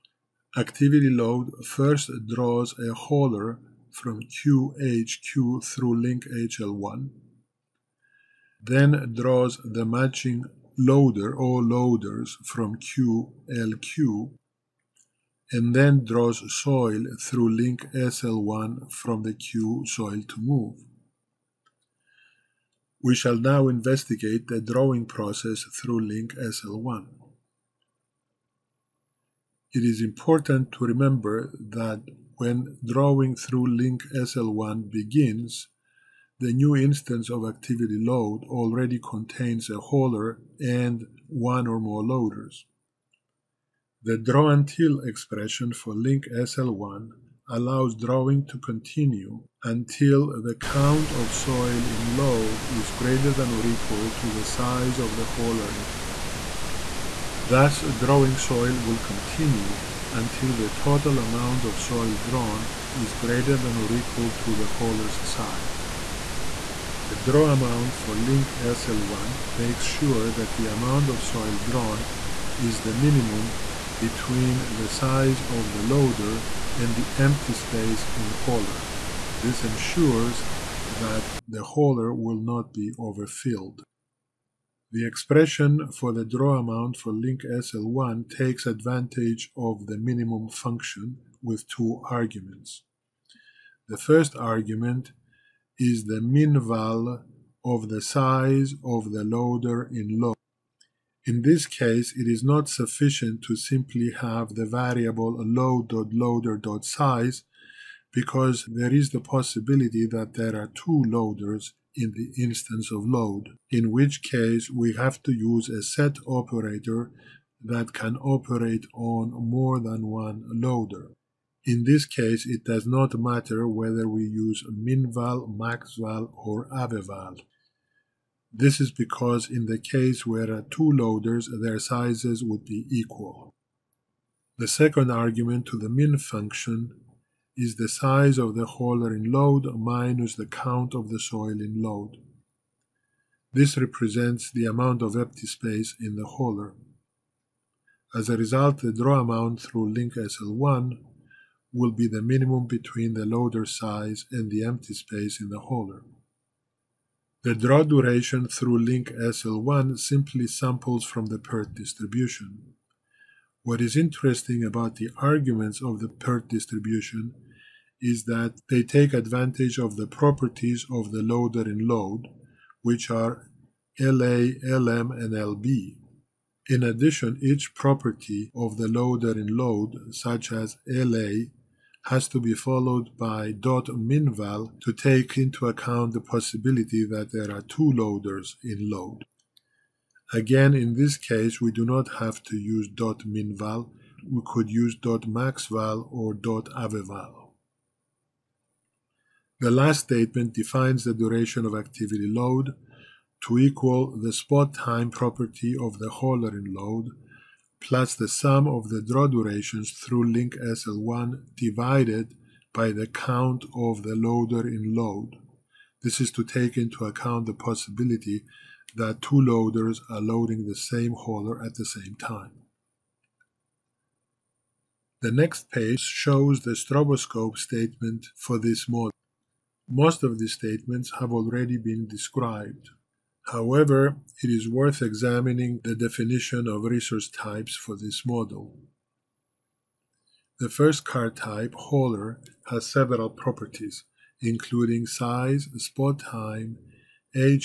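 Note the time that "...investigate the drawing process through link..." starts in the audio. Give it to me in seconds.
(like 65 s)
23 s.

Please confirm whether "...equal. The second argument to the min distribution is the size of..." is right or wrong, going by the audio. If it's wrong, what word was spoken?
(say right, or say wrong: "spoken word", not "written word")
wrong: "function", not "distribution".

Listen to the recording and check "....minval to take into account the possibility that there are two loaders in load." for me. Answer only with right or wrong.
right.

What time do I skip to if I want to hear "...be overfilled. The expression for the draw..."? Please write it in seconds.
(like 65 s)
82 s.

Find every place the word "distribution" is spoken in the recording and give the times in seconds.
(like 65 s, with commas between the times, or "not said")
161 s, 166 s.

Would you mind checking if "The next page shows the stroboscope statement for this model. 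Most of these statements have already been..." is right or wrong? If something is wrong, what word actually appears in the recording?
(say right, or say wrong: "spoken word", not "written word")
right.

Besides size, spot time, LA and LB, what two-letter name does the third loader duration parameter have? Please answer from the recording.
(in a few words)
LM.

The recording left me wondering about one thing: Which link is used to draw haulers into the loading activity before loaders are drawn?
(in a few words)
HL1.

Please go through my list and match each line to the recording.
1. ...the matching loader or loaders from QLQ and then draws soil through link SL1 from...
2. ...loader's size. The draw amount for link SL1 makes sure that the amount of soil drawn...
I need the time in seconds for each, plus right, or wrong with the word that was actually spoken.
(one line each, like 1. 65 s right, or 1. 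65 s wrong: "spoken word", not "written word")
1. 9 s right
2. 64 s wrong: "hauler", not "loader".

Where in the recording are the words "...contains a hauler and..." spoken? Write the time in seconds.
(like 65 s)
38 s.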